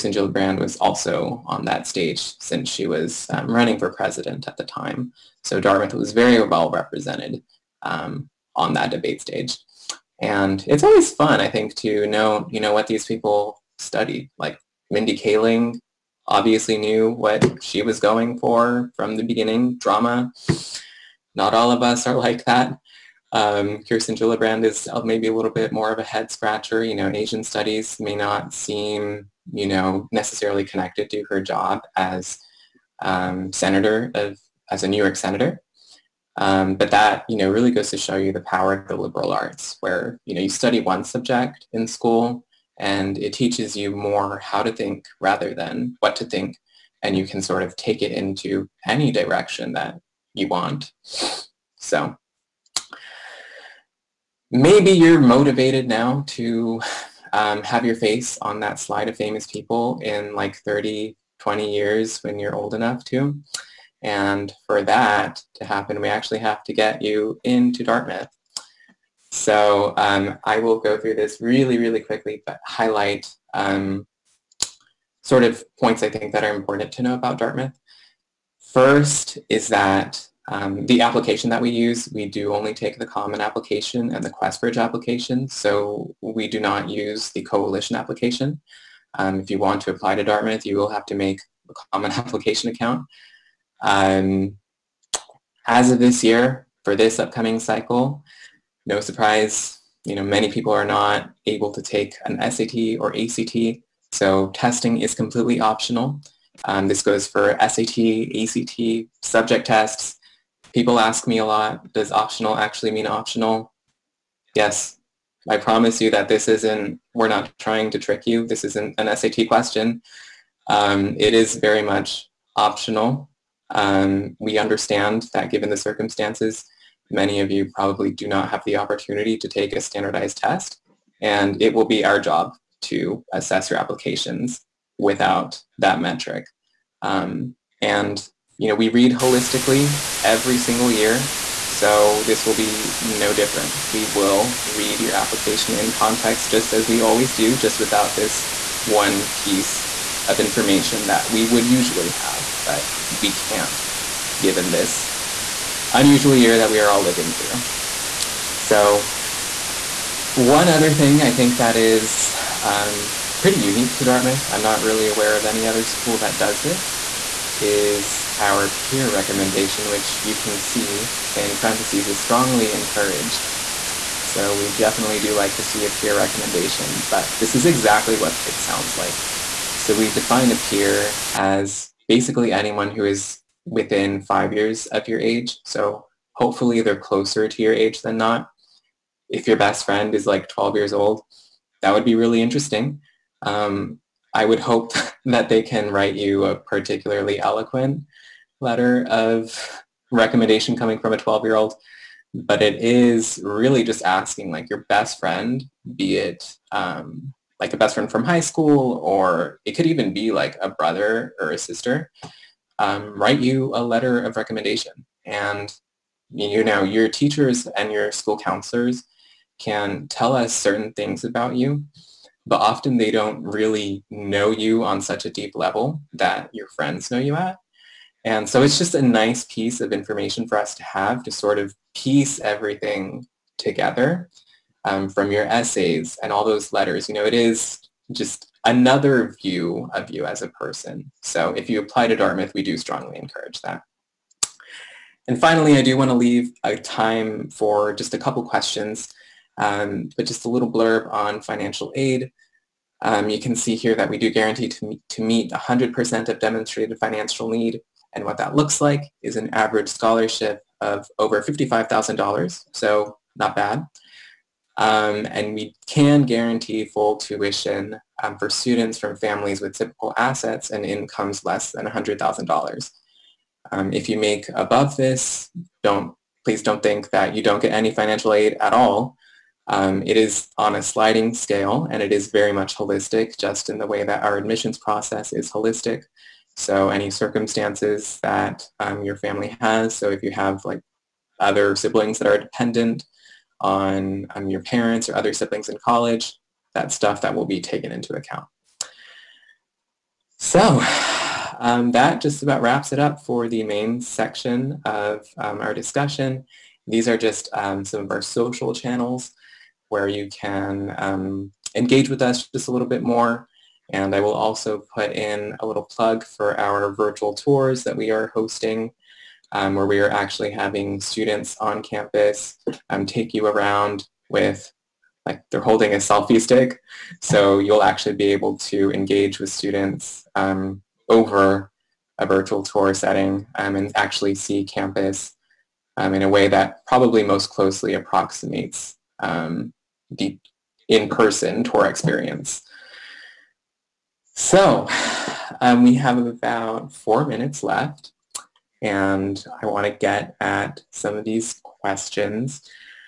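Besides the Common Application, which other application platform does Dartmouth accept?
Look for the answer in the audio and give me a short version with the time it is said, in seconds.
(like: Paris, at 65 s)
QuestBridge, at 84 s.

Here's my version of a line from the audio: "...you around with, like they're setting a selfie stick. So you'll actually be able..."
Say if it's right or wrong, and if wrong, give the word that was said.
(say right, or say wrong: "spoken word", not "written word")
wrong: "holding", not "setting".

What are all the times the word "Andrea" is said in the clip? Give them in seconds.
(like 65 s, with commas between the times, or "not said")
not said.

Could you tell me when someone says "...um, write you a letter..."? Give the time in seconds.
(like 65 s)
212 s.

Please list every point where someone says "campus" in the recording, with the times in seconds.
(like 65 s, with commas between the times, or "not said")
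321 s, 334 s.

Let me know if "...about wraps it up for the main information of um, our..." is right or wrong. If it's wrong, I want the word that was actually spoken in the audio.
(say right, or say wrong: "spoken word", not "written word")
wrong: "section", not "information".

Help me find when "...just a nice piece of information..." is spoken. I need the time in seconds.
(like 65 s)
228 s.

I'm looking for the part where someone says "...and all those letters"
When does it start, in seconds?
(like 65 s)
236 s.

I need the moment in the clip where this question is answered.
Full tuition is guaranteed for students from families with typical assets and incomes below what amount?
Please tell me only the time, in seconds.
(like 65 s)
271 s.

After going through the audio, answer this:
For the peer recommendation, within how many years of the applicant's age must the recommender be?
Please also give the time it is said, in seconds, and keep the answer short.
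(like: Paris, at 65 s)
5, at 184 s.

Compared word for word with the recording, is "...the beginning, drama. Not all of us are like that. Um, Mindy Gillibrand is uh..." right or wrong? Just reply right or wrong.
wrong.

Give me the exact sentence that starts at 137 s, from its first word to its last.
Um, and you know, we read holistically every single year.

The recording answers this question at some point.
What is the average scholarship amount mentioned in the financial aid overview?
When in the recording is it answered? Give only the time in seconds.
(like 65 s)
261 s.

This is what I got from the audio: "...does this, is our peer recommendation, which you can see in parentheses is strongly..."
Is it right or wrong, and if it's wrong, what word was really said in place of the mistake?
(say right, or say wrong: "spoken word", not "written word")
right.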